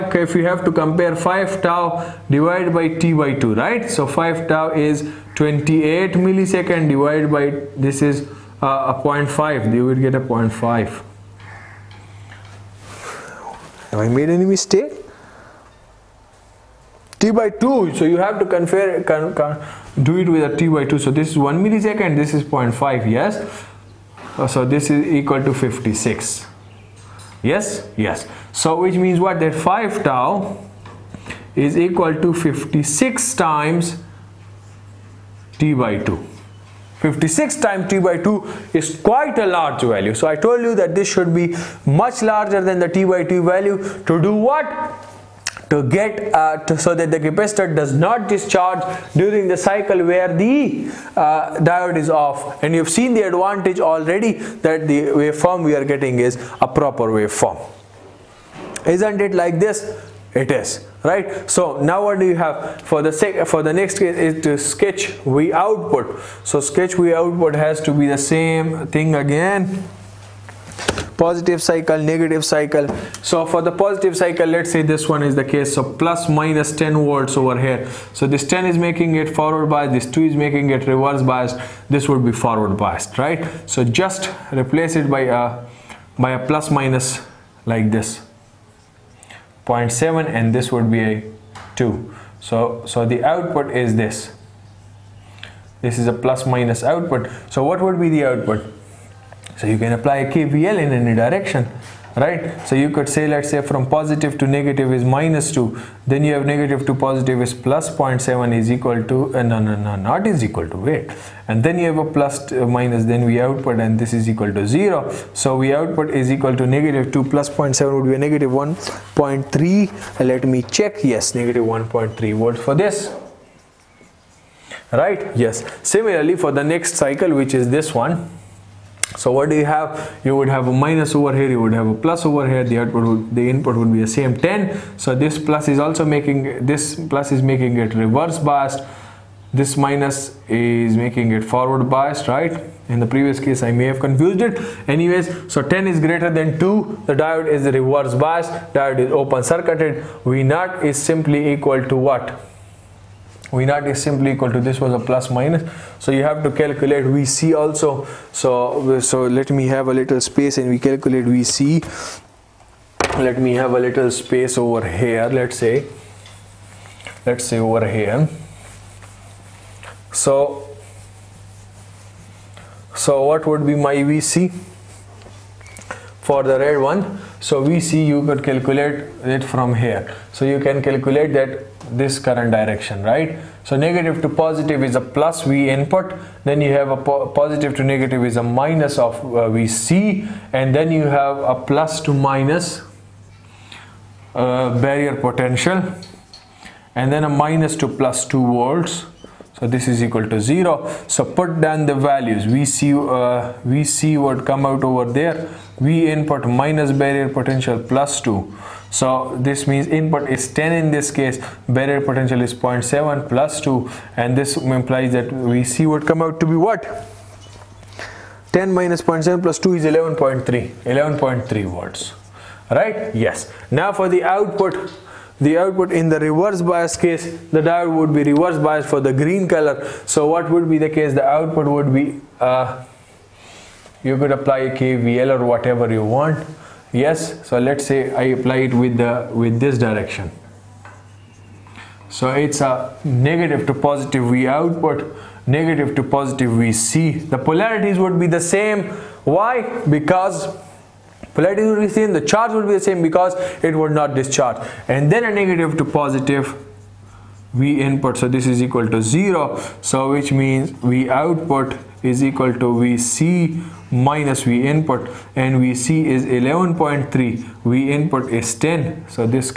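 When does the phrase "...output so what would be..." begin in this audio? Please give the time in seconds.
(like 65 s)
96 s.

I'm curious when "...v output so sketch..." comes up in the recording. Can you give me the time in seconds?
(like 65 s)
65 s.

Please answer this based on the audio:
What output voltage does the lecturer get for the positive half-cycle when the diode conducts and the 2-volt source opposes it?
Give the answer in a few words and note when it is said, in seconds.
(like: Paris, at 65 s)
-1.3 volts, at 121 s.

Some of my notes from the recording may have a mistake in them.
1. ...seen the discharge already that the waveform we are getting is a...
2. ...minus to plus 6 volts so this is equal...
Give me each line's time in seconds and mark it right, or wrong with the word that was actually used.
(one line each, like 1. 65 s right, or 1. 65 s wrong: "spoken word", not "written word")
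1. 52 s wrong: "advantage", not "discharge"
2. 197 s wrong: "2", not "6".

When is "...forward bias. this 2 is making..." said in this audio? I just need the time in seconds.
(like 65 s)
79 s.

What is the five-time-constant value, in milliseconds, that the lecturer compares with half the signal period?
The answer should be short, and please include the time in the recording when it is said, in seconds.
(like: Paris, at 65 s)
28 milliseconds, at 5 s.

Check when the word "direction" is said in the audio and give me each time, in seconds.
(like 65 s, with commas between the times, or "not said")
101 s, 182 s, 239 s.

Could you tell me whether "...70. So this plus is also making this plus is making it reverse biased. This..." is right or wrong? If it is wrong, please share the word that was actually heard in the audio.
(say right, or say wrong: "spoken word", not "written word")
wrong: "10", not "70".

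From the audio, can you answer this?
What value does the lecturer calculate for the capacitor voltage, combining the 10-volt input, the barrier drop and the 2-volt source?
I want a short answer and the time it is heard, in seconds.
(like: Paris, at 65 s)
11.3 volts, at 220 s.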